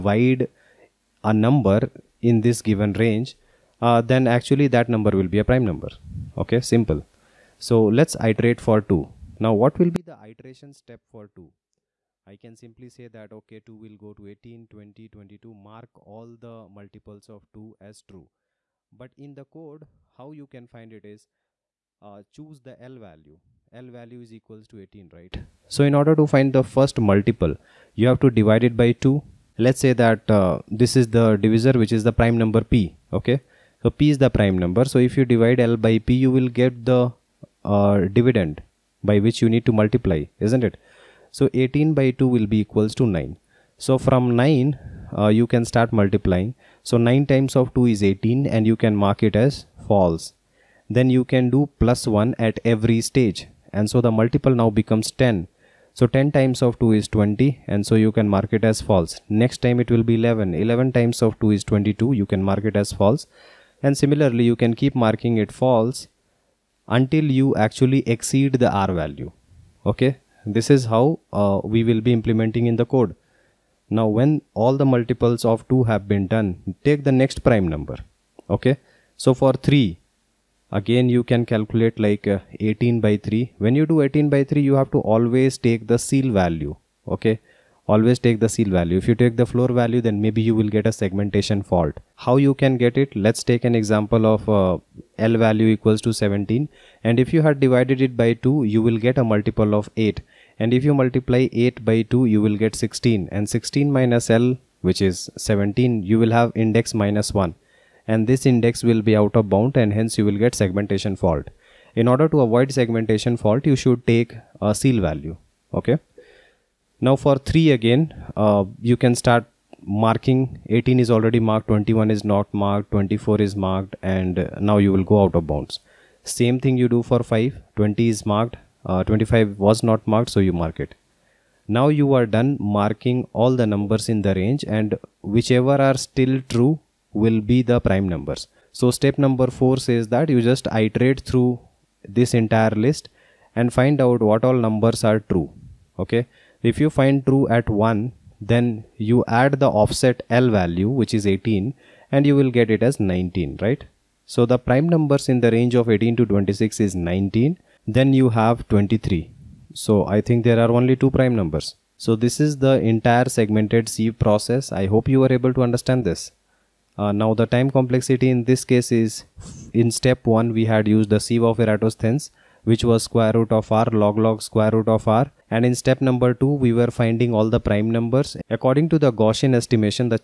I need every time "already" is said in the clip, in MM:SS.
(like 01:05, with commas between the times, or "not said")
02:01.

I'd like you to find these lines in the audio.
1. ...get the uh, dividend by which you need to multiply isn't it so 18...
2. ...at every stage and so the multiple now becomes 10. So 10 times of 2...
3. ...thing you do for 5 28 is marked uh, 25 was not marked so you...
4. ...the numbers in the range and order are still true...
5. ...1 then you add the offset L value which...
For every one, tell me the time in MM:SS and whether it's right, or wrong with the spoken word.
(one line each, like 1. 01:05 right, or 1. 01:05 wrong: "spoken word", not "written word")
1. 00:36 right
2. 00:52 right
3. 02:06 wrong: "20", not "28"
4. 02:13 wrong: "whichever", not "order"
5. 02:27 right.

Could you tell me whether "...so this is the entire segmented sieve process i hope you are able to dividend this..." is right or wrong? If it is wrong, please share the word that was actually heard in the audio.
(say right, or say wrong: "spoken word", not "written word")
wrong: "understand", not "dividend".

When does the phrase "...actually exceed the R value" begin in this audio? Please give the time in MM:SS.
01:07.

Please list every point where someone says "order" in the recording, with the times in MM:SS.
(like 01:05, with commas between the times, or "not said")
00:26, 01:52.